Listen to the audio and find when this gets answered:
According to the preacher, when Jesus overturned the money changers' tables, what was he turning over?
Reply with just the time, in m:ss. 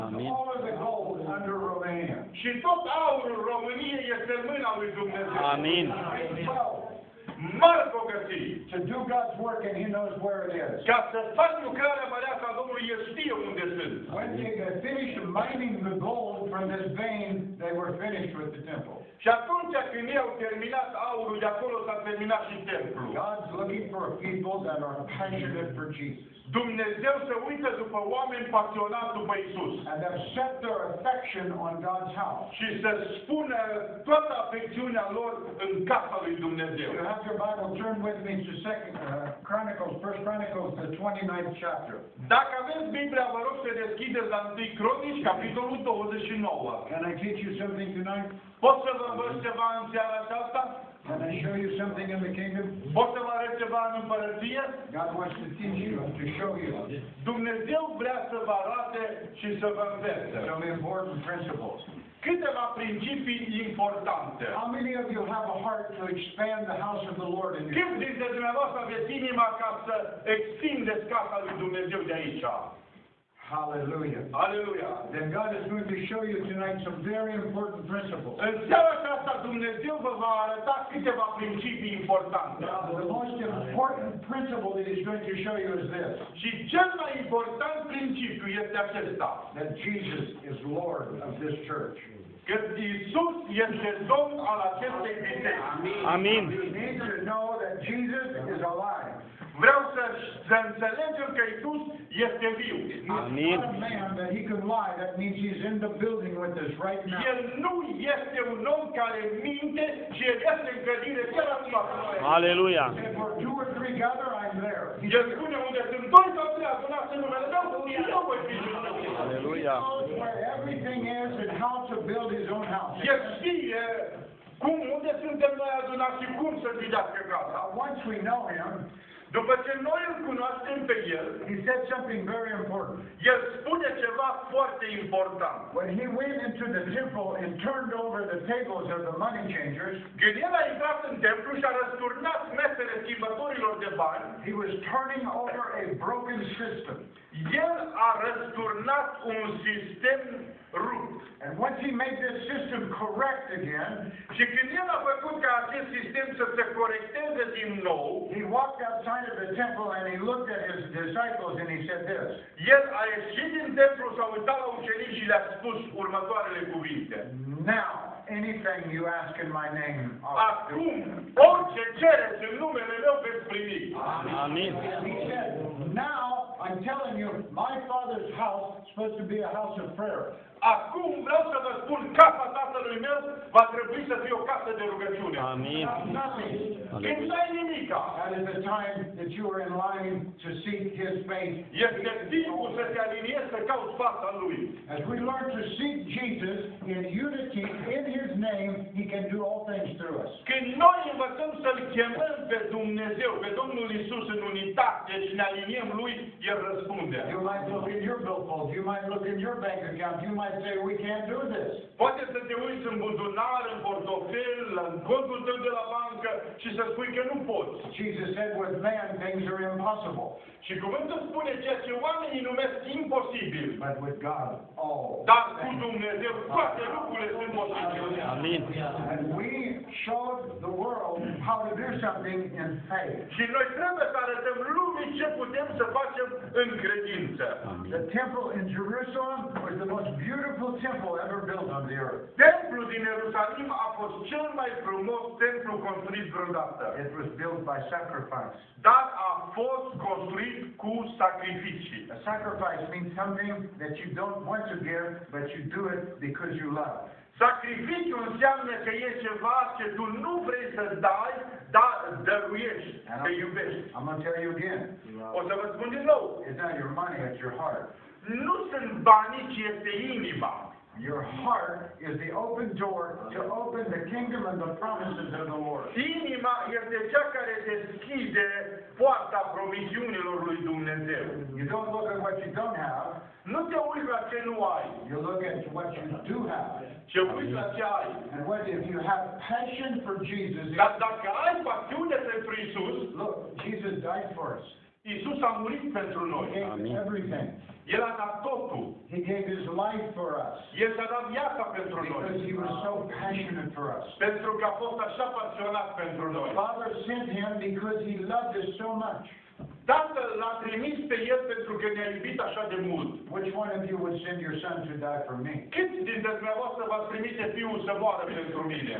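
2:25.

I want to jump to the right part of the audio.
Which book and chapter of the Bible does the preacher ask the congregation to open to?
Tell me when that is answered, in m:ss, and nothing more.
0:40.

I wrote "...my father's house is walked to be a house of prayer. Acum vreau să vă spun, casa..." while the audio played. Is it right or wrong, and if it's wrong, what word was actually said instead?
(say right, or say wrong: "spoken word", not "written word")
wrong: "supposed", not "walked".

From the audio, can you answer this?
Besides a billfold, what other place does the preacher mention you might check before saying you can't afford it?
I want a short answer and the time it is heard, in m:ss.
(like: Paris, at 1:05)
Bank account, at 3:29.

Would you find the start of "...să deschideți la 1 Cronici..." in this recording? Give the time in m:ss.
0:43.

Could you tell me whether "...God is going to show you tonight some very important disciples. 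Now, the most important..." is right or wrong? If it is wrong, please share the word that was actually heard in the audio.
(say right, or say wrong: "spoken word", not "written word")
wrong: "principles", not "disciples".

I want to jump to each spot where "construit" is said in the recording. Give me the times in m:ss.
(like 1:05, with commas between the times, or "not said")
4:05, 4:10.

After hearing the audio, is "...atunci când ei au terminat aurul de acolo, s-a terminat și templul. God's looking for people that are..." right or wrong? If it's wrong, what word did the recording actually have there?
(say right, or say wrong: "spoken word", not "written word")
right.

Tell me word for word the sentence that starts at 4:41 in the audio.
You don't look at what you don't have.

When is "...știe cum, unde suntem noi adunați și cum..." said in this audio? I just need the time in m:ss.
2:03.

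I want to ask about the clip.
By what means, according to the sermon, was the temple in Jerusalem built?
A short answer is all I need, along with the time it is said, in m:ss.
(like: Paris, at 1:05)
By sacrifice, at 4:07.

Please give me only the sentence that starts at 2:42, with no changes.
El a ieșit din templu, s-a uitat la ucenici și le-a spus următoarele cuvinte.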